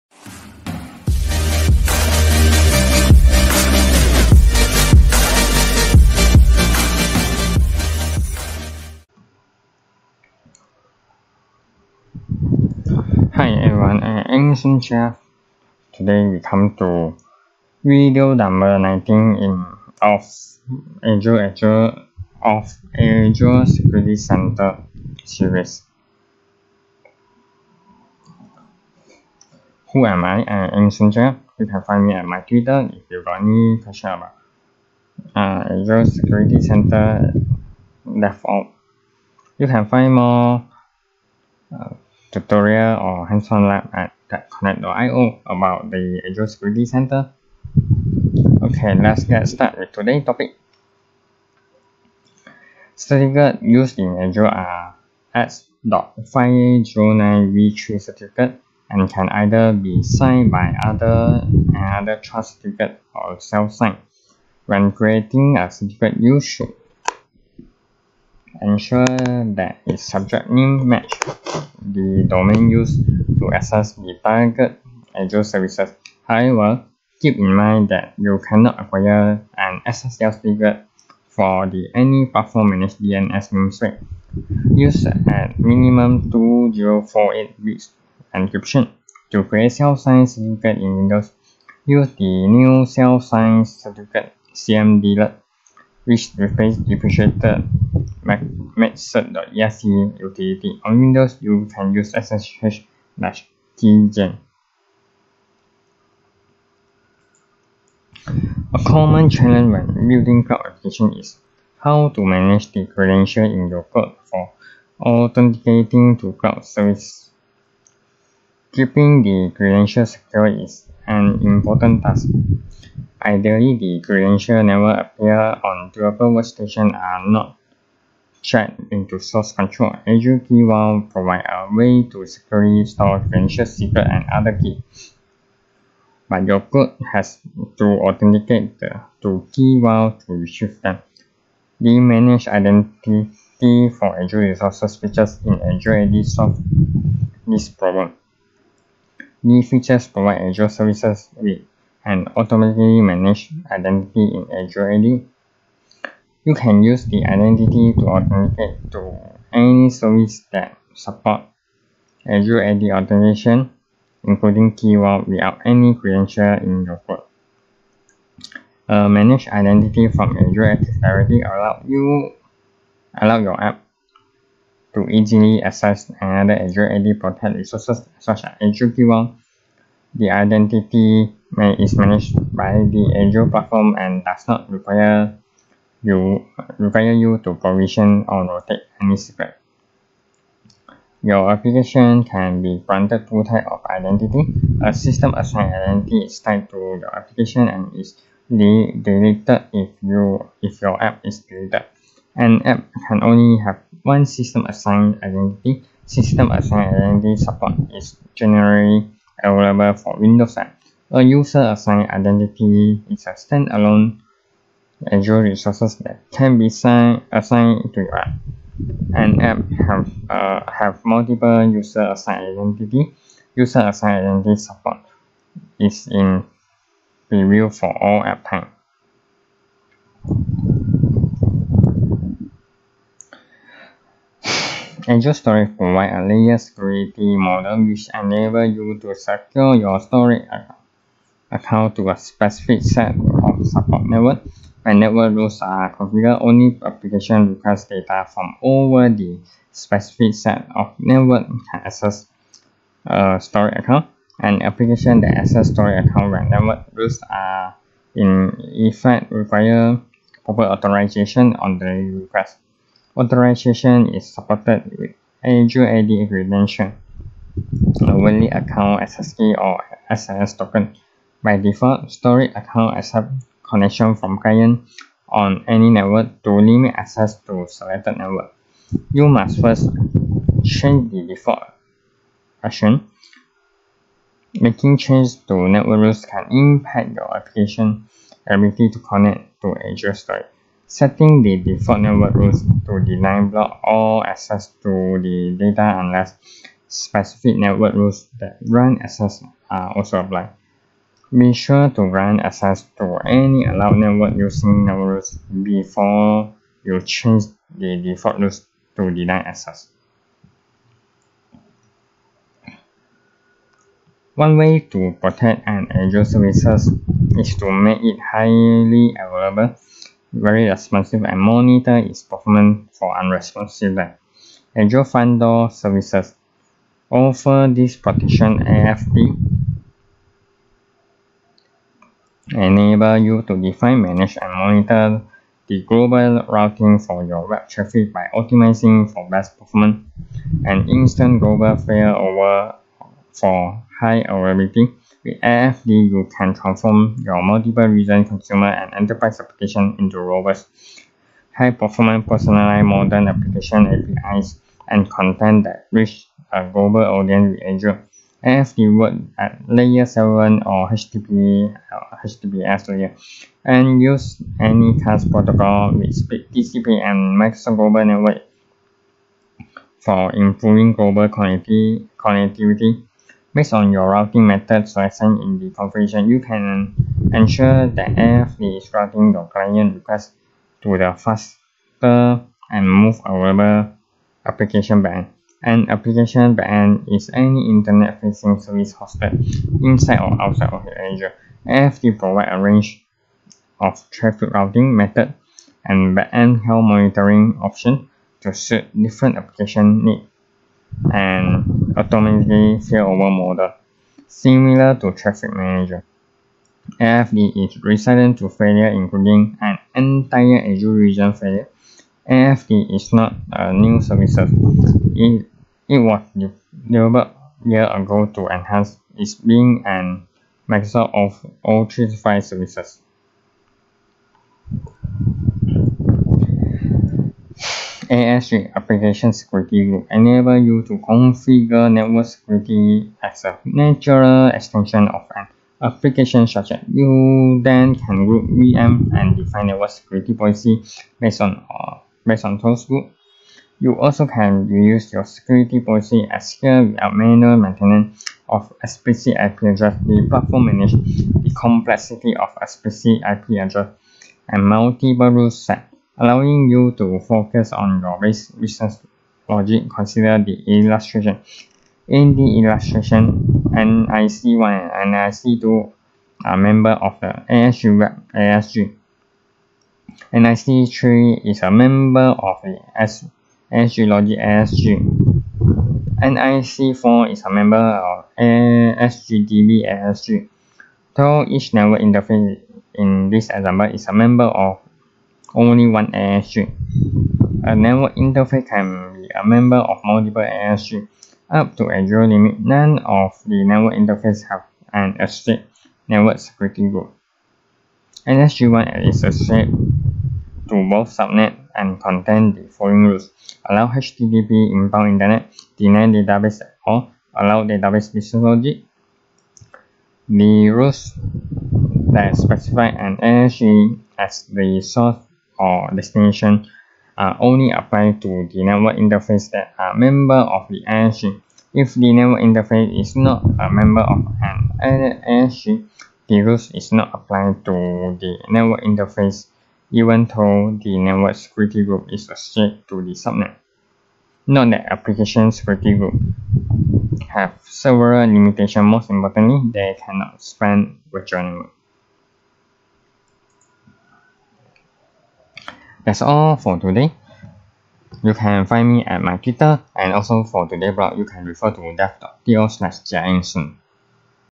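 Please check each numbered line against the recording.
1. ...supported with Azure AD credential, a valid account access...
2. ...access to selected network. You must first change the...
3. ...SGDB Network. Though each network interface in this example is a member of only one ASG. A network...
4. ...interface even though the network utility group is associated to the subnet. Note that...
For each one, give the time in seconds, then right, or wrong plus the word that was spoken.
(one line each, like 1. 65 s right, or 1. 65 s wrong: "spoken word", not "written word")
1. 264 s right
2. 276 s right
3. 478 s wrong: "ASG", not "Network"
4. 528 s wrong: "security", not "utility".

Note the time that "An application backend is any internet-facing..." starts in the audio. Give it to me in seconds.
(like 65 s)
385 s.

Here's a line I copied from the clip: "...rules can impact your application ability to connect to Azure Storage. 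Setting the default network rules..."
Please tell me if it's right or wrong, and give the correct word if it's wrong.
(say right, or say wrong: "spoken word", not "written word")
right.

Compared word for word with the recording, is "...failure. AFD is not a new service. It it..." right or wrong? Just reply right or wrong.
right.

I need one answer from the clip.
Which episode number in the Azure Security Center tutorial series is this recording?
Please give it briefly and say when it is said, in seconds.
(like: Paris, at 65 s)
19, at 18 s.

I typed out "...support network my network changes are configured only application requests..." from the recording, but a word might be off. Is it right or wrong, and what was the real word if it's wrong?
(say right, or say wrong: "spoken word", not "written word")
wrong: "rules", not "changes".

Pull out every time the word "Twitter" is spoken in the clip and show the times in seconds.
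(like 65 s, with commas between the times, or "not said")
32 s, 549 s.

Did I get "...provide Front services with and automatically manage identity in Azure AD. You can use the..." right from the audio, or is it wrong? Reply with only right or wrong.
wrong.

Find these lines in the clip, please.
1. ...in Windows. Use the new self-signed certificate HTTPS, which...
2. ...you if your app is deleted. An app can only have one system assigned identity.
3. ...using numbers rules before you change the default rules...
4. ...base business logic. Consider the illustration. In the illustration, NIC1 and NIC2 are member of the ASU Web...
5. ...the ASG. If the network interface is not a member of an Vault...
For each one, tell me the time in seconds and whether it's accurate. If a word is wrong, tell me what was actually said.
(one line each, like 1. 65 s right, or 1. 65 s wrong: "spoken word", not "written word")
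1. 90 s wrong: "CMDLET", not "HTTPS"
2. 200 s right
3. 304 s right
4. 458 s right
5. 520 s wrong: "ASG", not "Vault".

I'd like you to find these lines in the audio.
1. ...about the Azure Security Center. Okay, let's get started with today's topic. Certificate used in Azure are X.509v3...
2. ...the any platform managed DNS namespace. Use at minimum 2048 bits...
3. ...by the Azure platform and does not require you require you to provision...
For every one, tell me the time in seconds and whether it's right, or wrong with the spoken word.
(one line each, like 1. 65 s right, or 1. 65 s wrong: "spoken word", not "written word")
1. 45 s right
2. 81 s right
3. 182 s right.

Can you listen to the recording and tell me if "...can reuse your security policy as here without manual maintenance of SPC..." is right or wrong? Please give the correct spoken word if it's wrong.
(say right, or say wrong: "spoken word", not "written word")
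right.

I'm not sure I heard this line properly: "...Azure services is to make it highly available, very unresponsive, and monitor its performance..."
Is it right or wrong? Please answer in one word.
wrong.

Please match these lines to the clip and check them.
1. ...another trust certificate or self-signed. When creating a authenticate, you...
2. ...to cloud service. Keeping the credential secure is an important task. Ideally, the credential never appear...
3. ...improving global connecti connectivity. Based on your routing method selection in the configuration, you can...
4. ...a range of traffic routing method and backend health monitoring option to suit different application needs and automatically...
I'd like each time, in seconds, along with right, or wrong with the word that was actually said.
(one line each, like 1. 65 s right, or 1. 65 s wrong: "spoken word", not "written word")
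1. 61 s wrong: "certificate", not "authenticate"
2. 116 s right
3. 370 s right
4. 392 s right.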